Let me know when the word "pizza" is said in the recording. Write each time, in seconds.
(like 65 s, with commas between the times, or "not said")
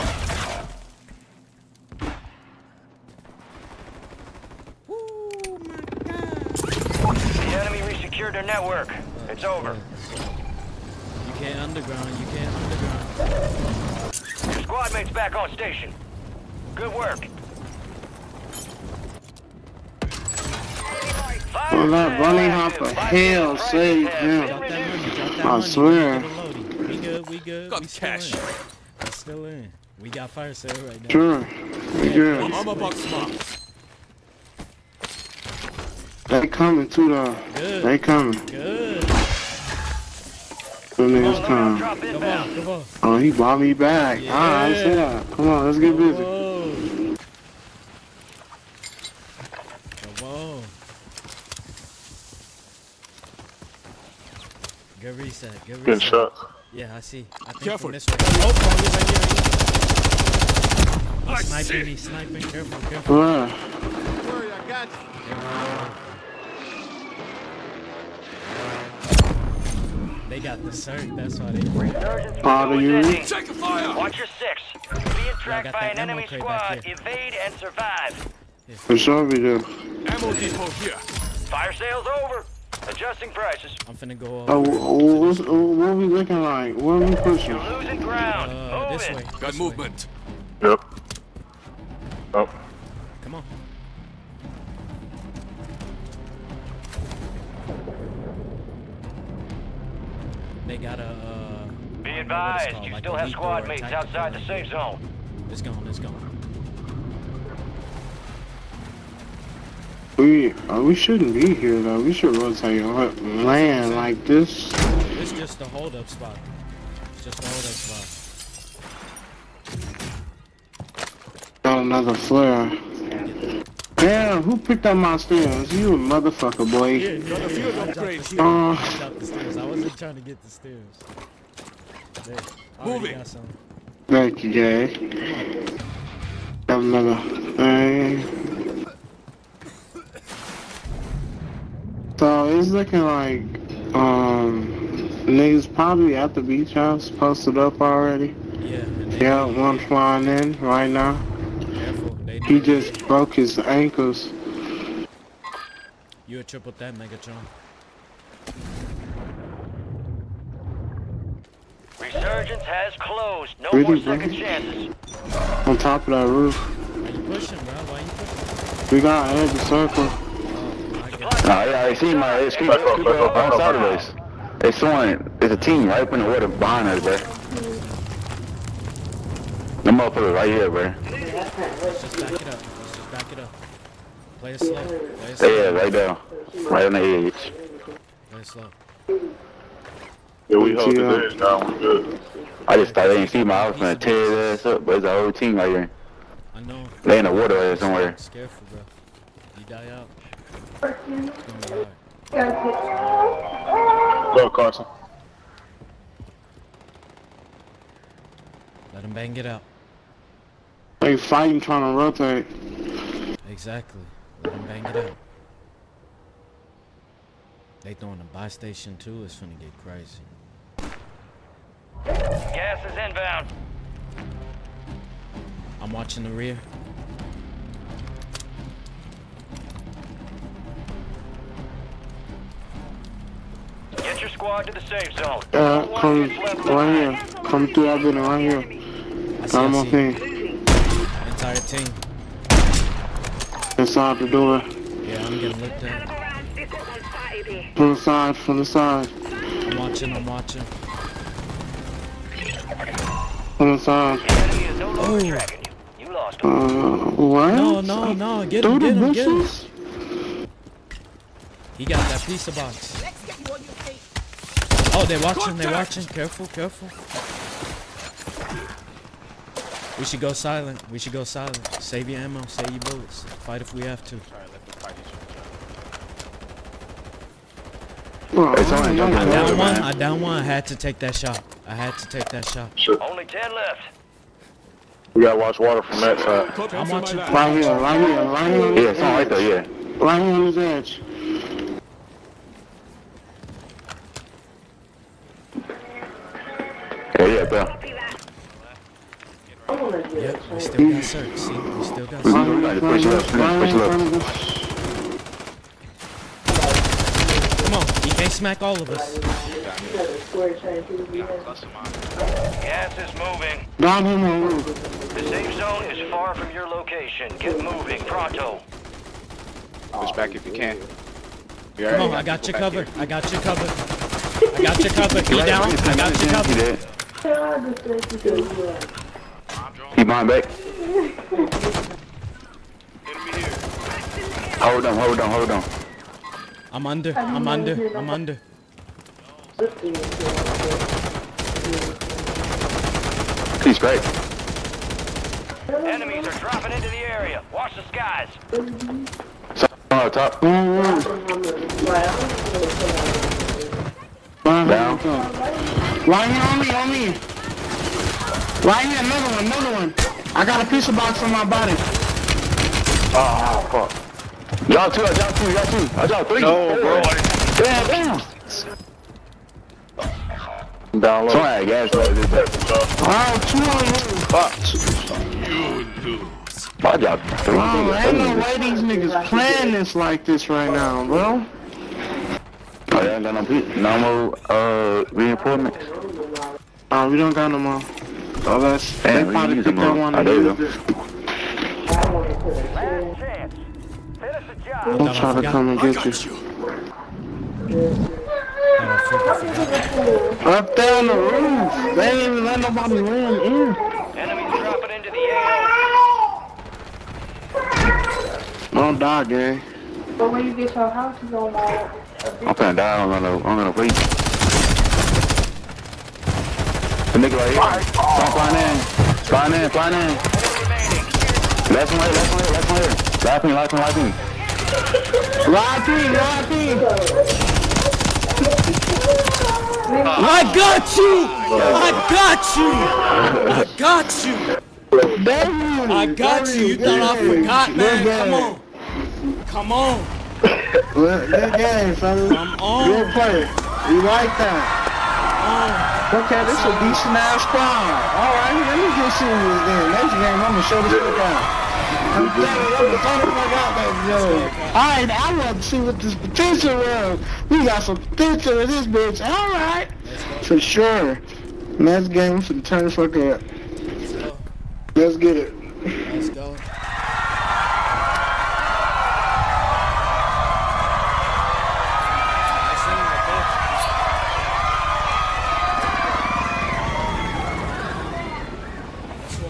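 262 s, 360 s.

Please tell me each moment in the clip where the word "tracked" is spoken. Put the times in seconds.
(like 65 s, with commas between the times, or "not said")
75 s.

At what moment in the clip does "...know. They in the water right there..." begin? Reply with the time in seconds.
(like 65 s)
196 s.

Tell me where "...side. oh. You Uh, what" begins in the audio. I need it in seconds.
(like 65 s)
253 s.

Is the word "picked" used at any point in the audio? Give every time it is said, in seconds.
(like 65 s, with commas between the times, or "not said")
124 s, 389 s.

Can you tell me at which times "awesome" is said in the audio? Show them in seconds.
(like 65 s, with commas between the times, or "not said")
not said.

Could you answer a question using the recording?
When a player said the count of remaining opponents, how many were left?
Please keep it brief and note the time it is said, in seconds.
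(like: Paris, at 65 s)
10, at 283 s.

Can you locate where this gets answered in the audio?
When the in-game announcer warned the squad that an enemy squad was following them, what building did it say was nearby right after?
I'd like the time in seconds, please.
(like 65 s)
80 s.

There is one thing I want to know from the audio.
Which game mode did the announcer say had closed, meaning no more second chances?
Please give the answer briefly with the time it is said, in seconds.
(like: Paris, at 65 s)
Resurgence, at 161 s.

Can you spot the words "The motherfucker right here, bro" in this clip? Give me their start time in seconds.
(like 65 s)
179 s.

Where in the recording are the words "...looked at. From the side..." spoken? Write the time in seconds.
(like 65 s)
245 s.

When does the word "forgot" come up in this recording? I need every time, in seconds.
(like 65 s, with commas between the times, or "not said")
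437 s.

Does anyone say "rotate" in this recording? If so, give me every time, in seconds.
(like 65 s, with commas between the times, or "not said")
112 s, 211 s.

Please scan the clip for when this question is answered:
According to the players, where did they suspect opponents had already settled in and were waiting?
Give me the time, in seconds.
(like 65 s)
146 s.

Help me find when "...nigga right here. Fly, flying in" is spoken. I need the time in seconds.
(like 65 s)
417 s.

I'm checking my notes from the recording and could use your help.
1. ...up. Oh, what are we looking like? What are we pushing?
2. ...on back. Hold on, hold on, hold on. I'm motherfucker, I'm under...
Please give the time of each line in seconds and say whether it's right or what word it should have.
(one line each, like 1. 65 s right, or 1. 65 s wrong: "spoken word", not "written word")
1. 84 s right
2. 330 s wrong: "under", not "motherfucker".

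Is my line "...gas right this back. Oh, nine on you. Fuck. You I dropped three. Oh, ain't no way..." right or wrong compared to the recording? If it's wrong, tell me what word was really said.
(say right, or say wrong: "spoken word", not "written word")
wrong: "two", not "nine".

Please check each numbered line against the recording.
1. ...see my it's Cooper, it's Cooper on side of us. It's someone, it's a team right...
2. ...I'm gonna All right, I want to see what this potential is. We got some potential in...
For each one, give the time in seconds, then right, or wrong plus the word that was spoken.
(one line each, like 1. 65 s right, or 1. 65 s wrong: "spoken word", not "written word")
1. 171 s right
2. 454 s right.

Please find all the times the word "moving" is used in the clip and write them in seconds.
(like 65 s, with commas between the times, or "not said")
313 s, 317 s.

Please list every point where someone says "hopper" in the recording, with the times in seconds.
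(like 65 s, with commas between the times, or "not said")
22 s.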